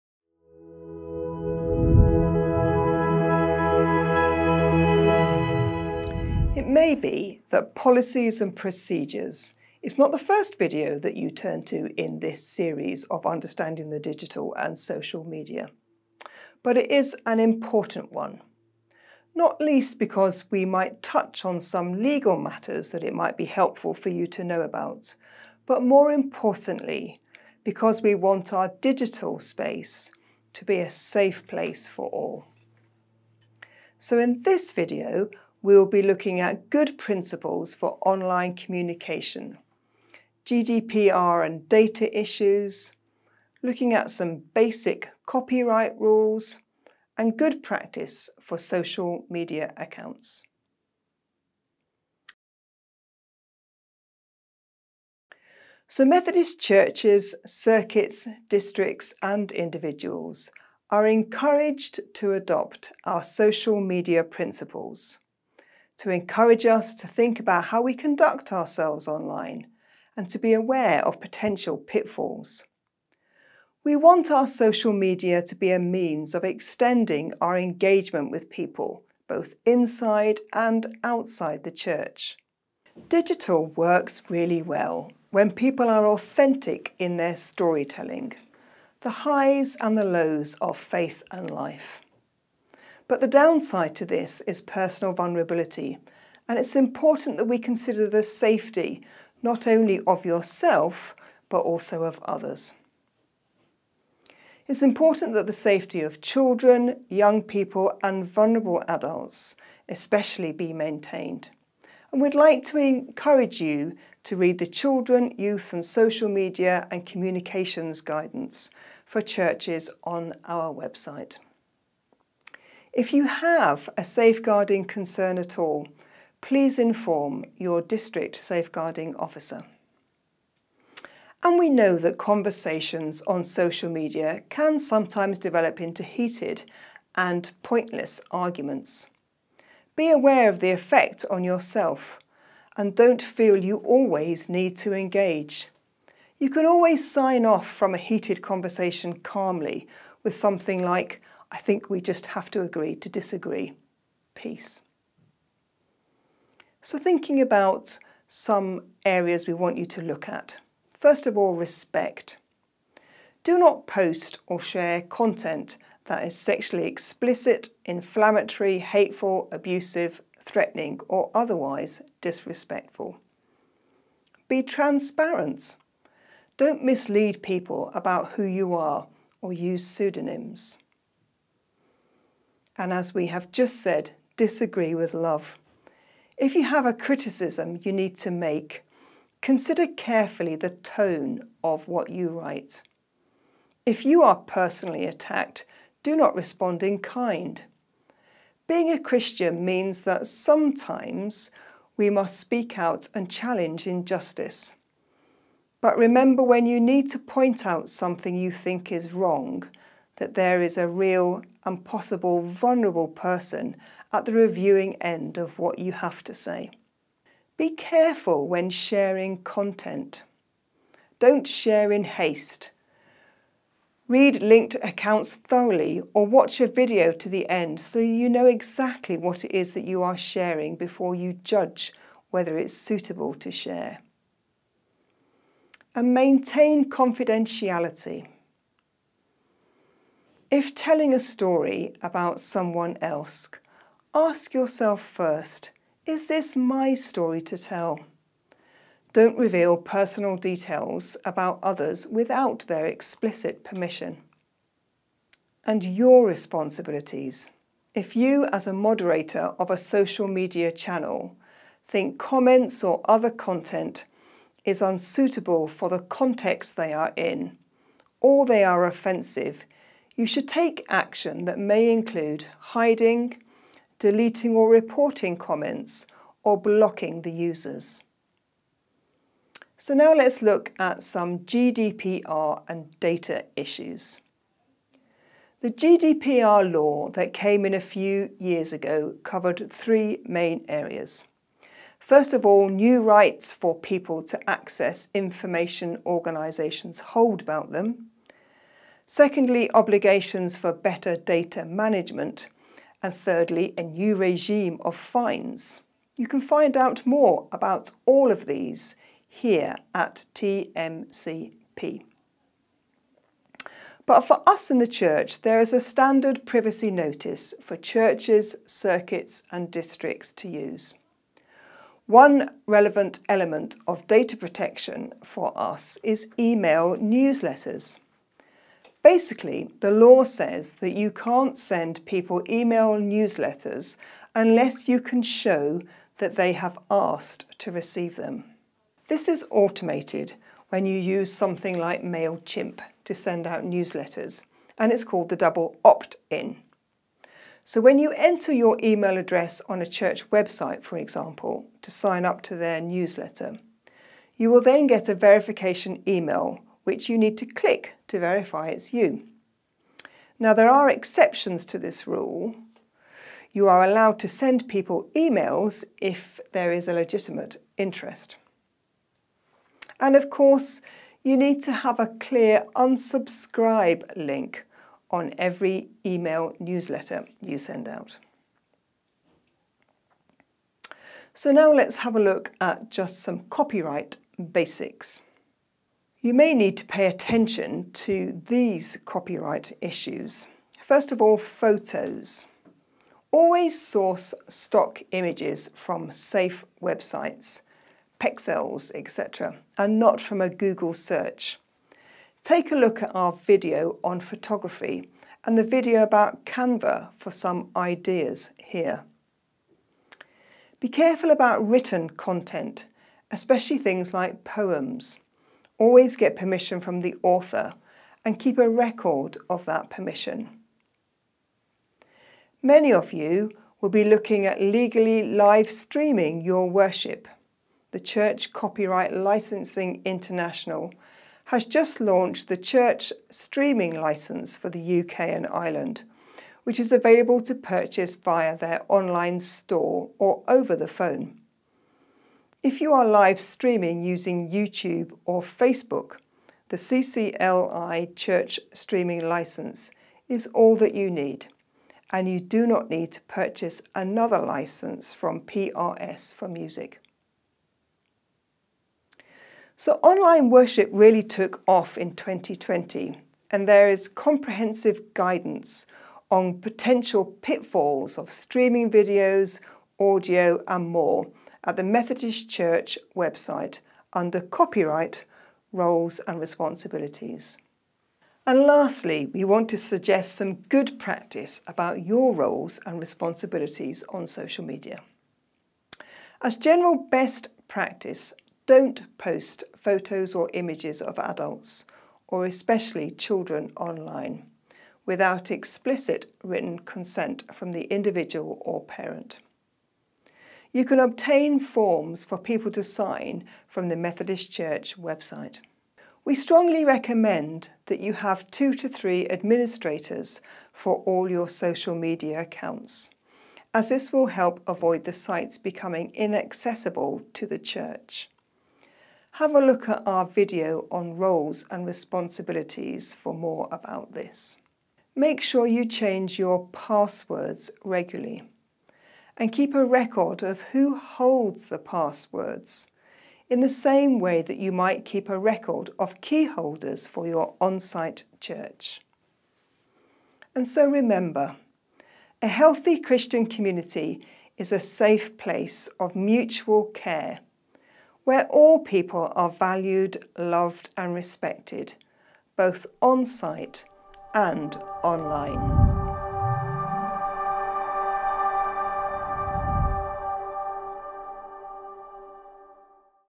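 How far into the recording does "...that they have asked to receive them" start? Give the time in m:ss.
5:36.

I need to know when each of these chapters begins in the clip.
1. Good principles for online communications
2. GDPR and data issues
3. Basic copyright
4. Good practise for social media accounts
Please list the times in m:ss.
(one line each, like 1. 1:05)
1. 0:53
2. 4:39
3. 6:19
4. 7:58.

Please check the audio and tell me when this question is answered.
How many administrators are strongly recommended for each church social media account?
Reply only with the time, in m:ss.
8:28.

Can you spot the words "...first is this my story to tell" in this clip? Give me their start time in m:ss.
4:05.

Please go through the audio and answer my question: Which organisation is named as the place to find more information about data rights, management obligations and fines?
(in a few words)
TMCP.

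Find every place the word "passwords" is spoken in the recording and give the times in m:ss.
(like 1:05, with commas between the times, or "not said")
8:46, 8:51.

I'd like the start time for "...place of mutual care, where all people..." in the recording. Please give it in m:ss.
9:05.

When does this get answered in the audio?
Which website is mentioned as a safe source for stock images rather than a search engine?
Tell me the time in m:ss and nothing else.
6:38.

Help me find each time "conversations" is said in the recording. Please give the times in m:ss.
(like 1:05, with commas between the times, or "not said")
2:12, 2:28.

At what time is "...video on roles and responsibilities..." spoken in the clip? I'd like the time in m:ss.
8:40.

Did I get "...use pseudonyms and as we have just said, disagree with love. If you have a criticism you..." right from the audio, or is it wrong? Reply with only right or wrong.
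right.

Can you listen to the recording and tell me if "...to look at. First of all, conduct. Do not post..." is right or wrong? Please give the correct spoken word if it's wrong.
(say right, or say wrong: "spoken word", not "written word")
wrong: "respect", not "conduct".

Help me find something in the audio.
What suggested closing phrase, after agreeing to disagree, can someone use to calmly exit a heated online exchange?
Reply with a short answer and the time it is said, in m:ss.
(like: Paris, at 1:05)
Peace, at 2:34.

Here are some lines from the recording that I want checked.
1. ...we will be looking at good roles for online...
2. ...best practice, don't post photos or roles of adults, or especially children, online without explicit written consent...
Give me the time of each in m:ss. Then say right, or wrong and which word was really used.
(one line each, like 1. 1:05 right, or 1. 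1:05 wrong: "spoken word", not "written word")
1. 0:35 wrong: "principles", not "roles"
2. 8:07 wrong: "images", not "roles".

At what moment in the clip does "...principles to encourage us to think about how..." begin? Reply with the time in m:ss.
1:04.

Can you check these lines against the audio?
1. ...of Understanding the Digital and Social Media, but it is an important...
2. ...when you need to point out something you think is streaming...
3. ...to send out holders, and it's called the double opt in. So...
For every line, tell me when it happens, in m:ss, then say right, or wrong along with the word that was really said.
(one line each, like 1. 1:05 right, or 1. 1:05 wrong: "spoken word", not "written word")
1. 0:13 right
2. 3:26 wrong: "wrong", not "streaming"
3. 5:43 wrong: "newsletters", not "holders".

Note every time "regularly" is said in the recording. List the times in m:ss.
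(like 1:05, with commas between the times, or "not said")
8:47.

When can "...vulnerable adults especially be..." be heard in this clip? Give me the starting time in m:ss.
1:48.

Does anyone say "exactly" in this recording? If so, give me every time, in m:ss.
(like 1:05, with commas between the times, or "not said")
3:48.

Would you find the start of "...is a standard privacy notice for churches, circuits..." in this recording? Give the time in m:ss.
5:15.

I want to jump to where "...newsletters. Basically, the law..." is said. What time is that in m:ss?
5:26.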